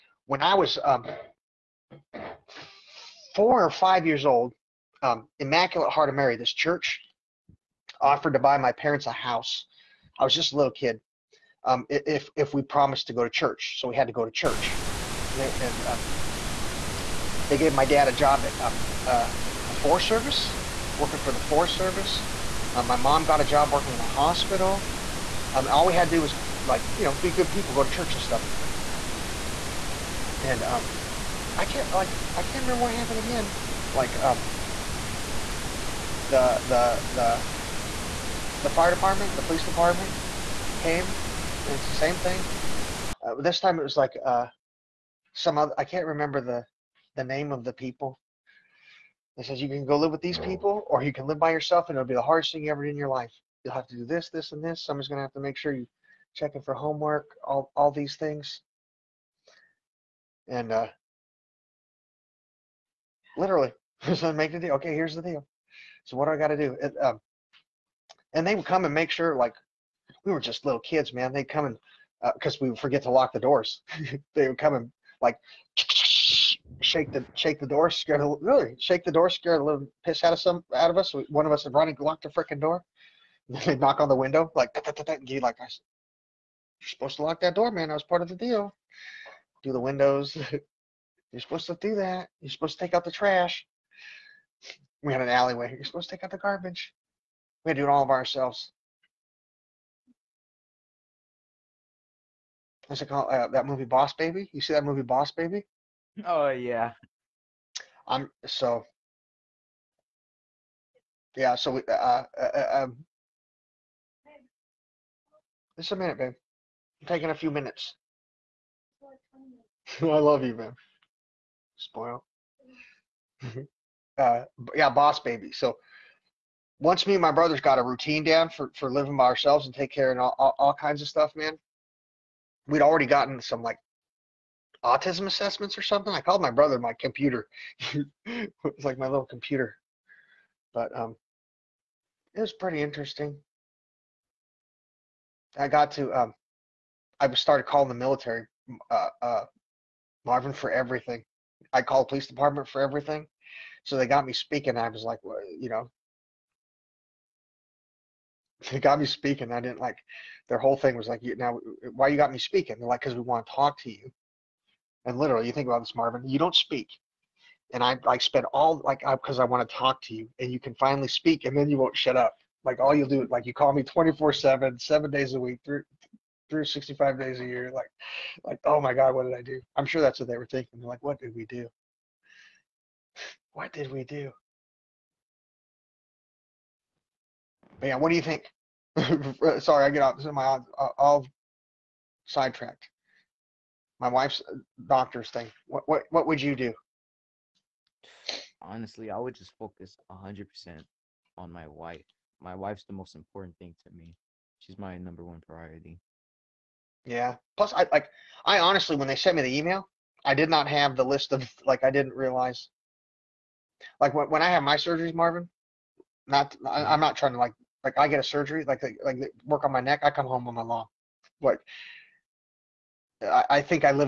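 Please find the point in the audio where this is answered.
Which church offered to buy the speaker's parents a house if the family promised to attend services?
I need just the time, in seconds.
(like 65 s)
5 s.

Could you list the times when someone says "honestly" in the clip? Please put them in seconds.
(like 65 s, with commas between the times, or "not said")
198 s, 208 s.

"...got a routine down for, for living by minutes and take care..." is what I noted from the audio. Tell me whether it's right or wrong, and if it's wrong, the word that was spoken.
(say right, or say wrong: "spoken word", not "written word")
wrong: "ourselves", not "minutes".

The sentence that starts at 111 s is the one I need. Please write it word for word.
Uh, uh, uh, um, just a minute, babe.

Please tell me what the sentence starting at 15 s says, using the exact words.
There and um, they gave my dad a job at um, uh, the Forest Service, working for the Forest Service.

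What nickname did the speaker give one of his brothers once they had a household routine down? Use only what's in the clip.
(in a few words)
my computer.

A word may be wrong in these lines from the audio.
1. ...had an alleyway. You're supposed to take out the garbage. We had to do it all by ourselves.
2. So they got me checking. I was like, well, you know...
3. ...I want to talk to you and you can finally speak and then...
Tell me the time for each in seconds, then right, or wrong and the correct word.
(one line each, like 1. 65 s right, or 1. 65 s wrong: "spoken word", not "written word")
1. 95 s right
2. 153 s wrong: "speaking", not "checking"
3. 169 s right.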